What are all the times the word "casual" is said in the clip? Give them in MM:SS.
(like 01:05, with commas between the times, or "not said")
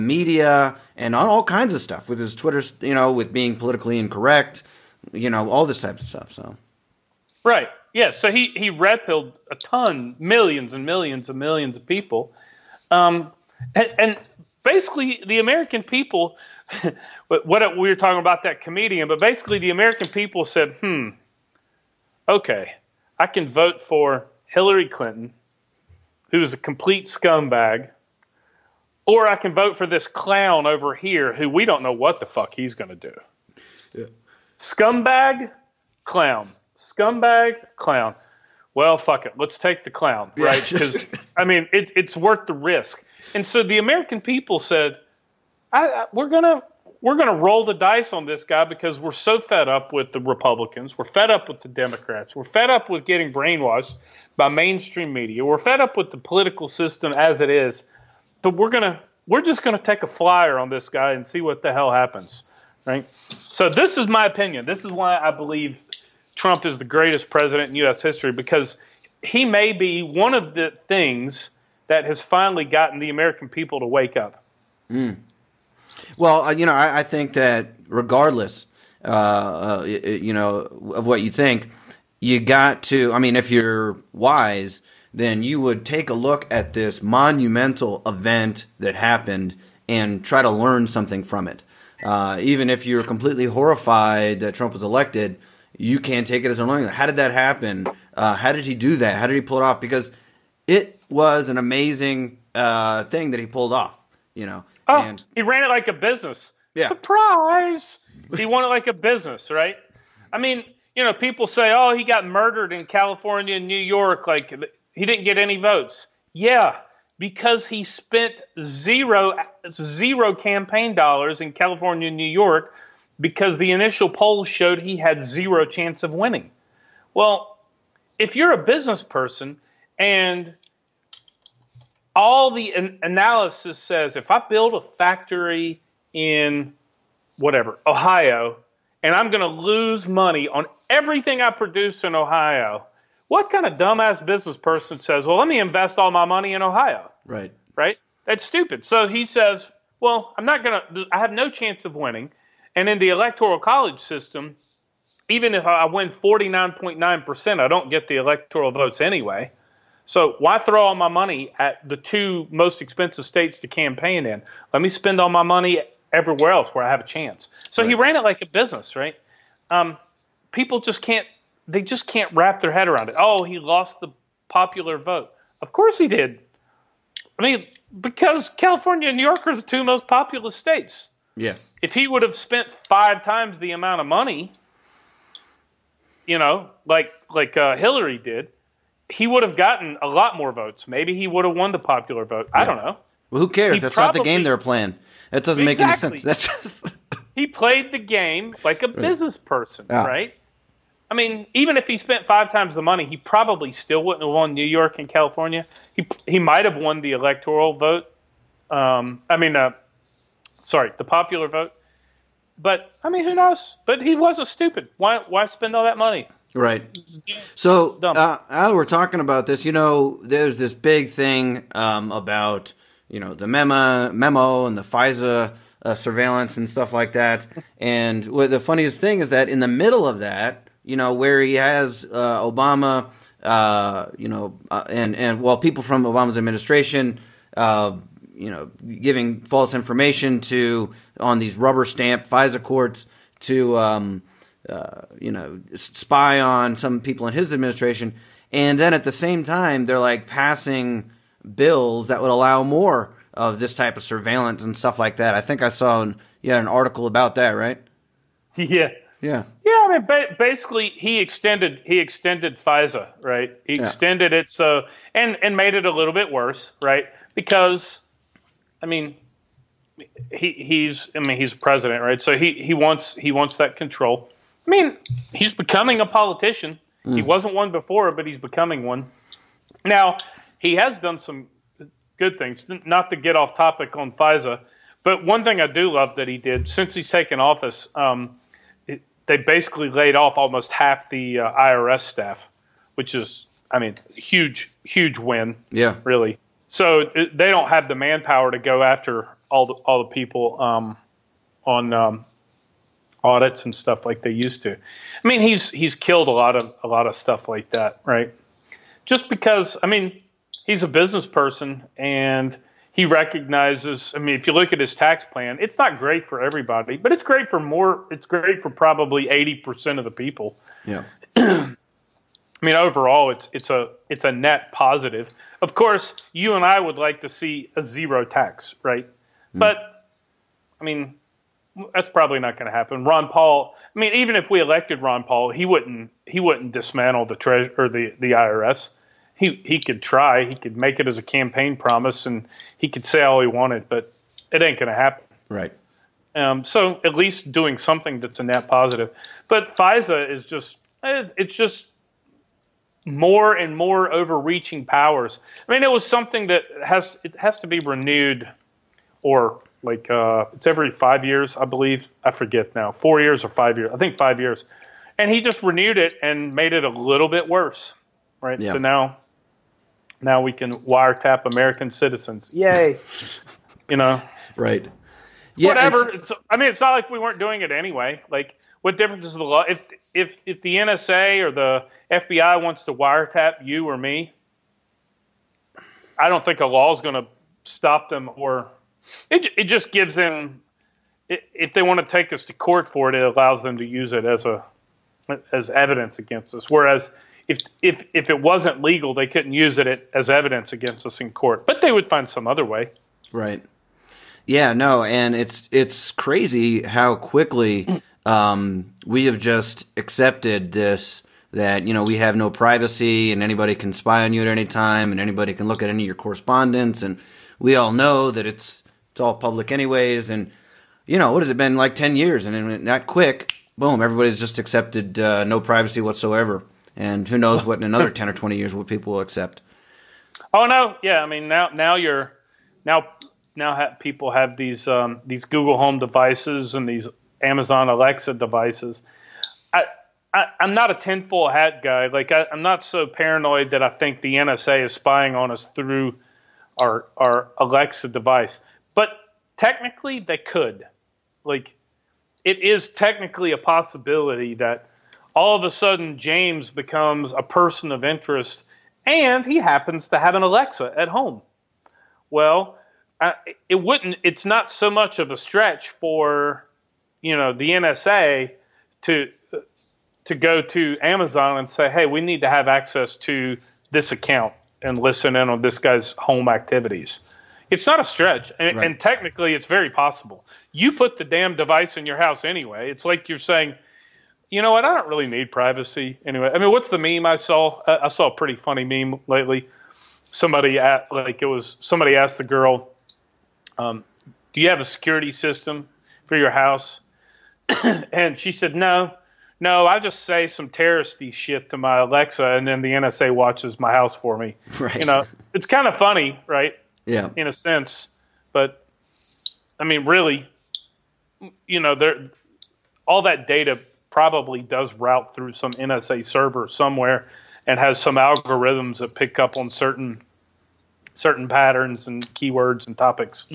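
not said.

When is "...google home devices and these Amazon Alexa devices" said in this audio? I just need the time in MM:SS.
07:15.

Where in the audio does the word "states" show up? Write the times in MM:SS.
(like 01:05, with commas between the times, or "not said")
02:43, 03:00.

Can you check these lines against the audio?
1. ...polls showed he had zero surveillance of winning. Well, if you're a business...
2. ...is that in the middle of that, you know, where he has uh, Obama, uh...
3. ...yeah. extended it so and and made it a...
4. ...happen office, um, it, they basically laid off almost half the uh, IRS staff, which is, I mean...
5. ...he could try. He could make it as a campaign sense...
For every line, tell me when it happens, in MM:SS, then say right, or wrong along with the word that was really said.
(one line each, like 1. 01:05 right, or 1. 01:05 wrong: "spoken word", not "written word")
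1. 02:04 wrong: "chance", not "surveillance"
2. 03:49 right
3. 04:23 right
4. 04:47 wrong: "taken", not "happen"
5. 05:39 wrong: "promise", not "sense".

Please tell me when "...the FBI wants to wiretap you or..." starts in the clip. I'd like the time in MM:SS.
06:21.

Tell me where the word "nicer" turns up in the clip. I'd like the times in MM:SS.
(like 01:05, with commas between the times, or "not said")
not said.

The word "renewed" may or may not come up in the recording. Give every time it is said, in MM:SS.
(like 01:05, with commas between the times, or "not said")
05:57, 06:05.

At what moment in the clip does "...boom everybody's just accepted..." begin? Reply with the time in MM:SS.
07:03.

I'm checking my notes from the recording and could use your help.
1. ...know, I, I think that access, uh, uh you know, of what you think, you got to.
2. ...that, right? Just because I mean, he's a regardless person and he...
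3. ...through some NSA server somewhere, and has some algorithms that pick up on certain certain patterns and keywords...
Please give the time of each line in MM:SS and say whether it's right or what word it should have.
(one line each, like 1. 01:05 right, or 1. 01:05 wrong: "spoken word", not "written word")
1. 01:16 wrong: "regardless", not "access"
2. 05:07 wrong: "business", not "regardless"
3. 08:35 right.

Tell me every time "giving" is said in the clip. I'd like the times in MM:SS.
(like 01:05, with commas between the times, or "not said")
03:59.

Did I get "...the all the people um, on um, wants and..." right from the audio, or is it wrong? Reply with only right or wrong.
wrong.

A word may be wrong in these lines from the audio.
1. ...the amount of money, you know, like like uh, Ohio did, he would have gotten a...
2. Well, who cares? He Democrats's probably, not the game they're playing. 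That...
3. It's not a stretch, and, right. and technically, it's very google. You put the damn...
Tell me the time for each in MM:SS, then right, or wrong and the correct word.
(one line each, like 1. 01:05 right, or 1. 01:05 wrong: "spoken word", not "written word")
1. 03:03 wrong: "Hillary", not "Ohio"
2. 03:13 wrong: "That", not "Democrats"
3. 07:57 wrong: "possible", not "google".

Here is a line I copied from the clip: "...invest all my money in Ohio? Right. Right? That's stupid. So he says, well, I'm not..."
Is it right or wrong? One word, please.
right.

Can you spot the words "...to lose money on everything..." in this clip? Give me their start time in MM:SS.
02:19.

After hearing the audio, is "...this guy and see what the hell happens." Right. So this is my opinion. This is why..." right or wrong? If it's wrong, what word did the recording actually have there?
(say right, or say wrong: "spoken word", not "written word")
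right.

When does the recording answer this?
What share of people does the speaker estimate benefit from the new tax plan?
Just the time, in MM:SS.
05:19.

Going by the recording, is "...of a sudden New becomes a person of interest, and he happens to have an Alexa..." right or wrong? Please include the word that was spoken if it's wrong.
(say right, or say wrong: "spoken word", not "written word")
wrong: "James", not "New".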